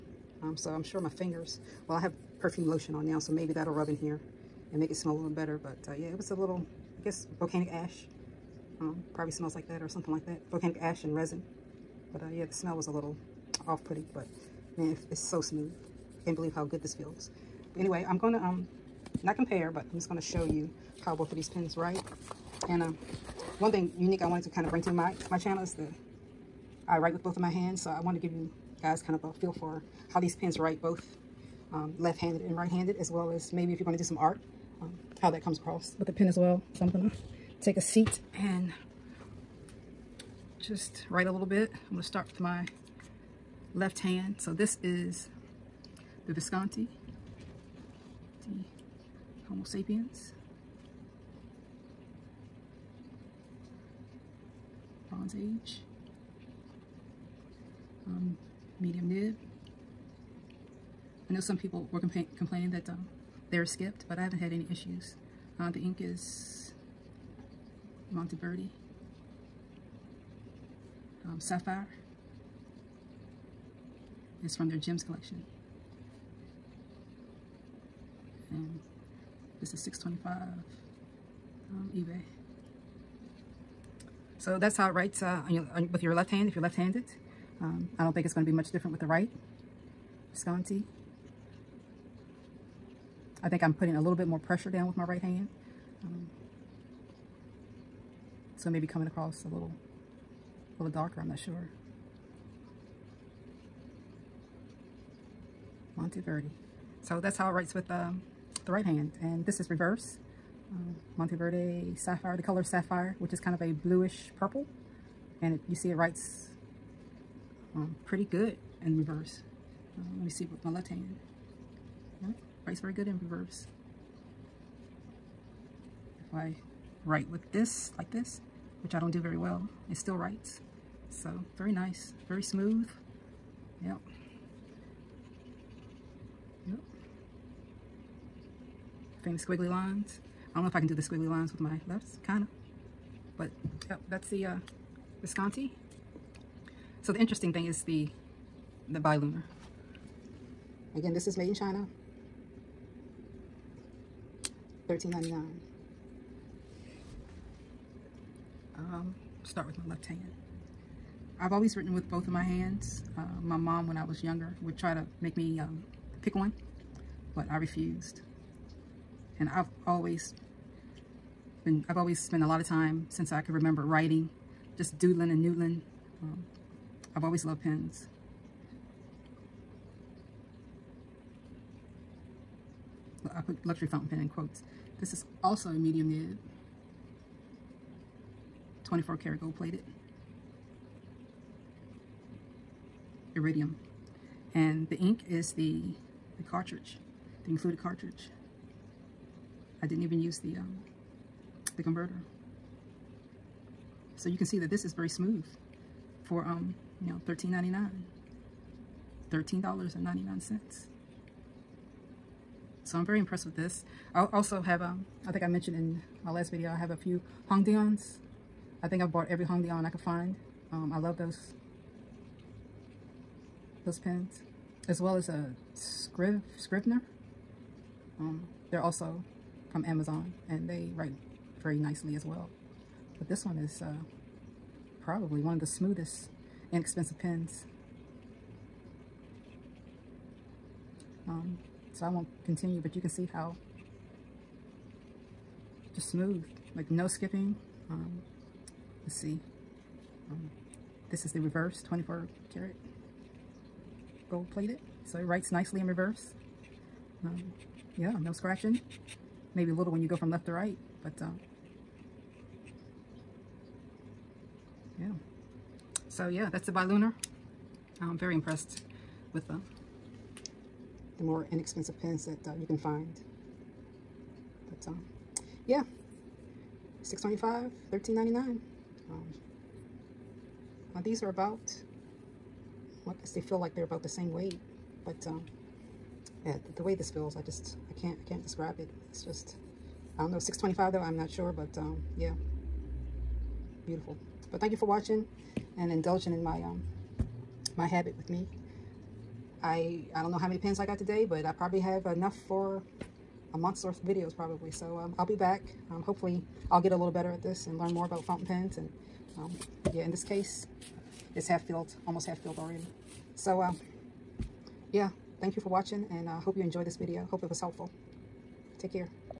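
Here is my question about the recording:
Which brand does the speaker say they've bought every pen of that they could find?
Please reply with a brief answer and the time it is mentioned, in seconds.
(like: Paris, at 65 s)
Hongdian, at 219 s.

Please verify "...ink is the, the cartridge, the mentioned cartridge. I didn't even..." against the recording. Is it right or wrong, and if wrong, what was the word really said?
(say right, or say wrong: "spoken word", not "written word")
wrong: "included", not "mentioned".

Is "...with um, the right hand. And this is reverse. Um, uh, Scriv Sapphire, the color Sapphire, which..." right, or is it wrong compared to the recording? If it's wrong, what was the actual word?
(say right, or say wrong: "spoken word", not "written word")
wrong: "Monteverde", not "Scriv".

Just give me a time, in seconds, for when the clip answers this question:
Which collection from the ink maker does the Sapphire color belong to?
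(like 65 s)
74 s.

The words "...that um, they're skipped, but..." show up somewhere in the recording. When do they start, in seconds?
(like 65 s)
62 s.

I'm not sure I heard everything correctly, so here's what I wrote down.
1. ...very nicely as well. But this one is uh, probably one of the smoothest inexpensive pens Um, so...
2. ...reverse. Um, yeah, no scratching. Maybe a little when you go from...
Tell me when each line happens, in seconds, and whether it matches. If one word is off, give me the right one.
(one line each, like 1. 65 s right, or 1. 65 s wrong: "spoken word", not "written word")
1. 231 s right
2. 255 s right.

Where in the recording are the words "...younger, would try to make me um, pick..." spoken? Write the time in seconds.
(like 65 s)
164 s.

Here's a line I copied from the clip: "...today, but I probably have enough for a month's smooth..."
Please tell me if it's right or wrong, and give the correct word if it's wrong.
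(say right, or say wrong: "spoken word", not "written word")
wrong: "worth", not "smooth".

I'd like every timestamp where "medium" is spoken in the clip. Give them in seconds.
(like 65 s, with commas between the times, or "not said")
58 s, 185 s.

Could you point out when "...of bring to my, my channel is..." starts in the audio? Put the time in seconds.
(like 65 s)
24 s.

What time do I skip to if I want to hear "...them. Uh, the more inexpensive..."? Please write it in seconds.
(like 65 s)
269 s.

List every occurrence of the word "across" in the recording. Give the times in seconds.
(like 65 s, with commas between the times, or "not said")
35 s, 99 s.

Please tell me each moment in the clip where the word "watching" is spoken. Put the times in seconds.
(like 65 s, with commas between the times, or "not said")
294 s, 315 s.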